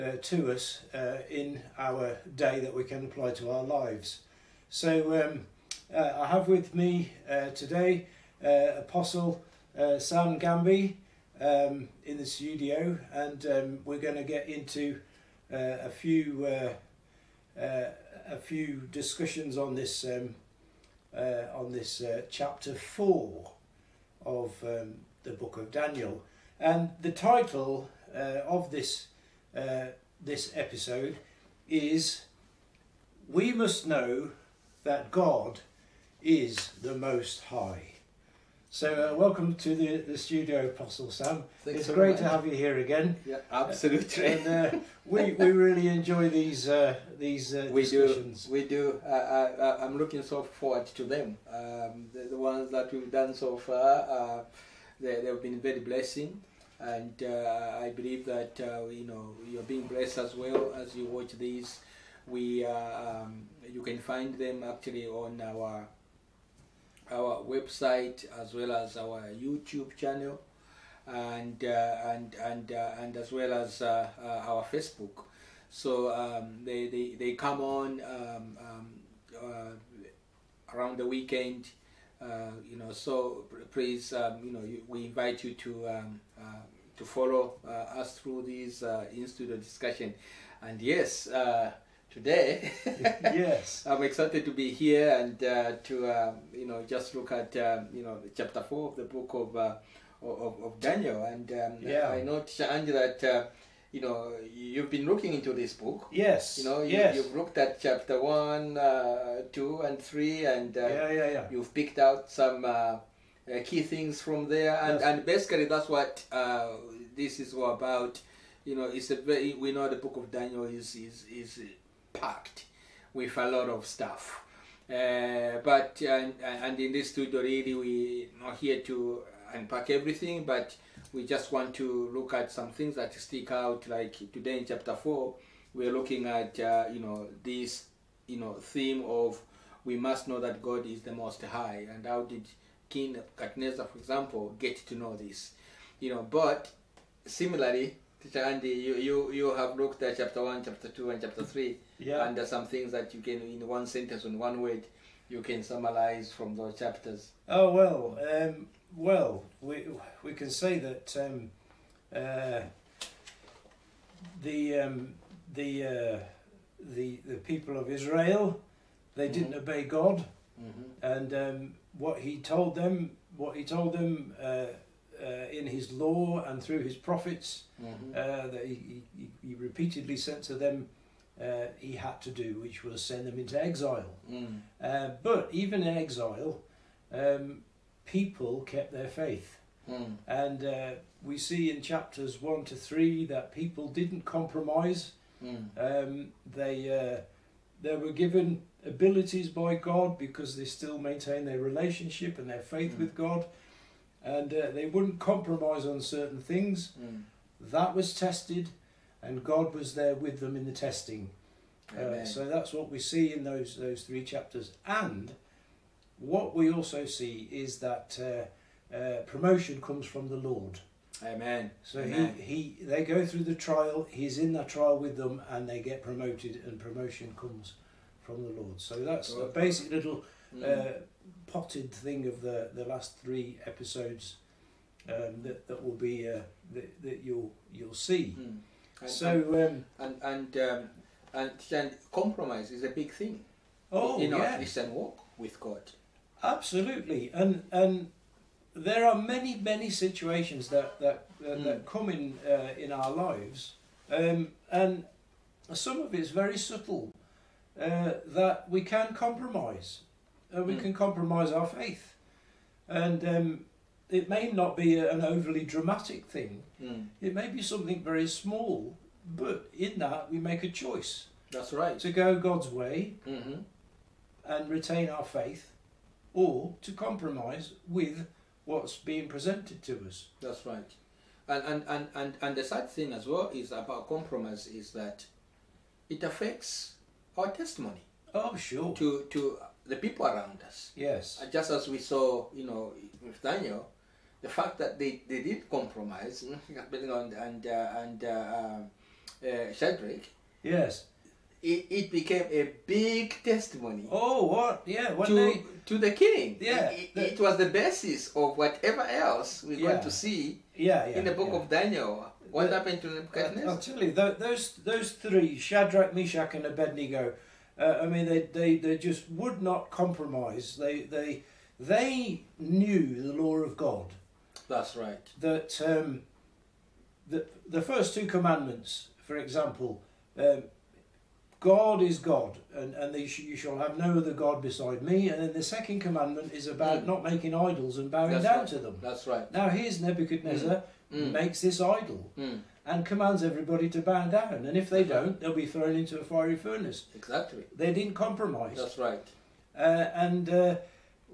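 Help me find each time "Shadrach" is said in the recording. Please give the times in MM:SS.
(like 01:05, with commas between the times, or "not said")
04:59, 05:15.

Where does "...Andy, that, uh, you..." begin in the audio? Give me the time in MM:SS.
01:42.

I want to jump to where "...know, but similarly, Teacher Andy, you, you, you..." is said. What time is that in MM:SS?
02:26.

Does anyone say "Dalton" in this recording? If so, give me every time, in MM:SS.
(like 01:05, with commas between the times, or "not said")
not said.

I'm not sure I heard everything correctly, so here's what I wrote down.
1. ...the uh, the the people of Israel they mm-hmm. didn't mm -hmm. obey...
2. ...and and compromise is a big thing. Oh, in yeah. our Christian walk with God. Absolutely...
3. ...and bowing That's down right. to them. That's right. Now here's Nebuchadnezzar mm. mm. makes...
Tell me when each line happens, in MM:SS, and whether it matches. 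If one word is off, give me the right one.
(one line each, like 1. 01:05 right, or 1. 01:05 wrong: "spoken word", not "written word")
1. 02:45 right
2. 04:01 right
3. 05:37 right.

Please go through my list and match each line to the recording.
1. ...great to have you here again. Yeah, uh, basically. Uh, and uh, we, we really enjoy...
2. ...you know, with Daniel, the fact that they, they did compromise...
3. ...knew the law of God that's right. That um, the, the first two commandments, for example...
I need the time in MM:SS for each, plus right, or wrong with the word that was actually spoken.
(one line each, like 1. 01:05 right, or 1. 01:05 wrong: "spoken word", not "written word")
1. 00:41 wrong: "absolutely", not "basically"
2. 04:52 right
3. 05:22 right.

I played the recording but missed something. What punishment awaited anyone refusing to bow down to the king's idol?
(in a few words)
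a fiery furnace.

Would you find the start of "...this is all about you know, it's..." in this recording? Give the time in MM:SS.
01:57.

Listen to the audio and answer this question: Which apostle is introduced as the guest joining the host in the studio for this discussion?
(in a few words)
Sam Ngambi.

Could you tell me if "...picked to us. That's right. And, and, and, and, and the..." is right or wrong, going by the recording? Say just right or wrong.
wrong.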